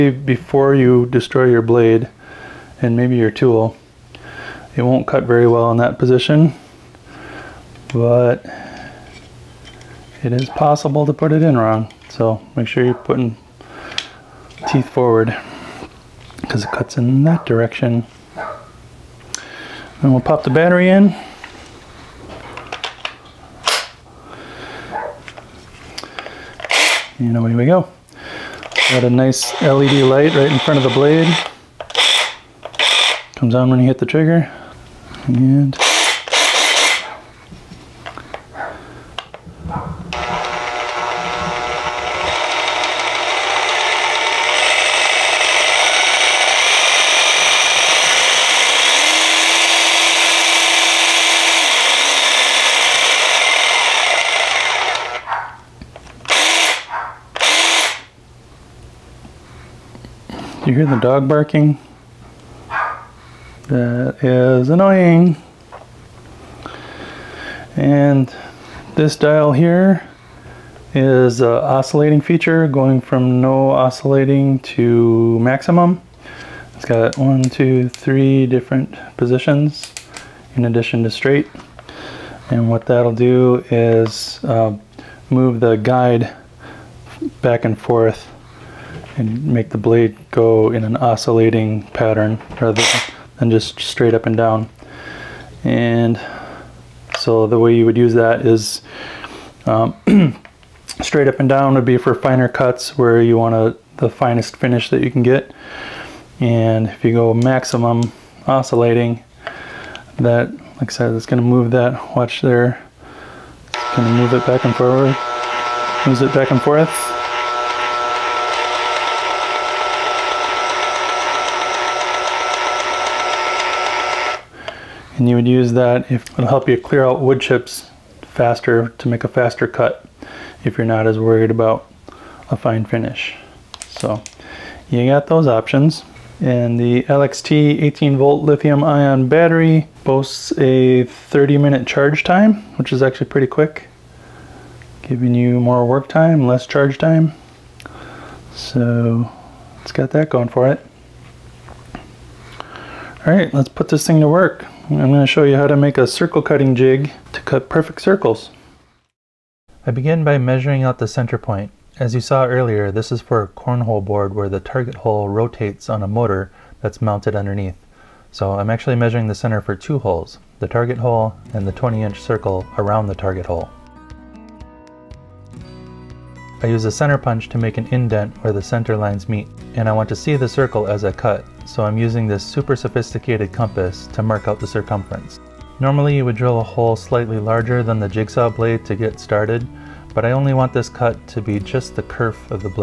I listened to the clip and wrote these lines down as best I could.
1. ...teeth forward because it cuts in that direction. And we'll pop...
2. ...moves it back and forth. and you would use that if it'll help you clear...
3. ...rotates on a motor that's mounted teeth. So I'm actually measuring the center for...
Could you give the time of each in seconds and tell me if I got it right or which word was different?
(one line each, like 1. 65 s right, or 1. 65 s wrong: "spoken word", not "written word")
1. 14 s right
2. 116 s right
3. 165 s wrong: "underneath", not "teeth".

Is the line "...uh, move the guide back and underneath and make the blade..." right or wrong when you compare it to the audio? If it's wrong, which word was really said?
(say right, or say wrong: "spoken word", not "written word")
wrong: "forth", not "underneath".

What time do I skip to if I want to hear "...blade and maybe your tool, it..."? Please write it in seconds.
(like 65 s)
1 s.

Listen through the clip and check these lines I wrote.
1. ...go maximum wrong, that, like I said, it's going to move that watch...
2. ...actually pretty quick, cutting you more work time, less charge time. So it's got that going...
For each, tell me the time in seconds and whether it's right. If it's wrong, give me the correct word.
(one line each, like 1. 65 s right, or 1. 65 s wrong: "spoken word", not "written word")
1. 107 s wrong: "oscillating", not "wrong"
2. 143 s wrong: "giving", not "cutting".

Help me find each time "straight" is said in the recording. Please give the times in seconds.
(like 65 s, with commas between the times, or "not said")
81 s, 93 s, 101 s.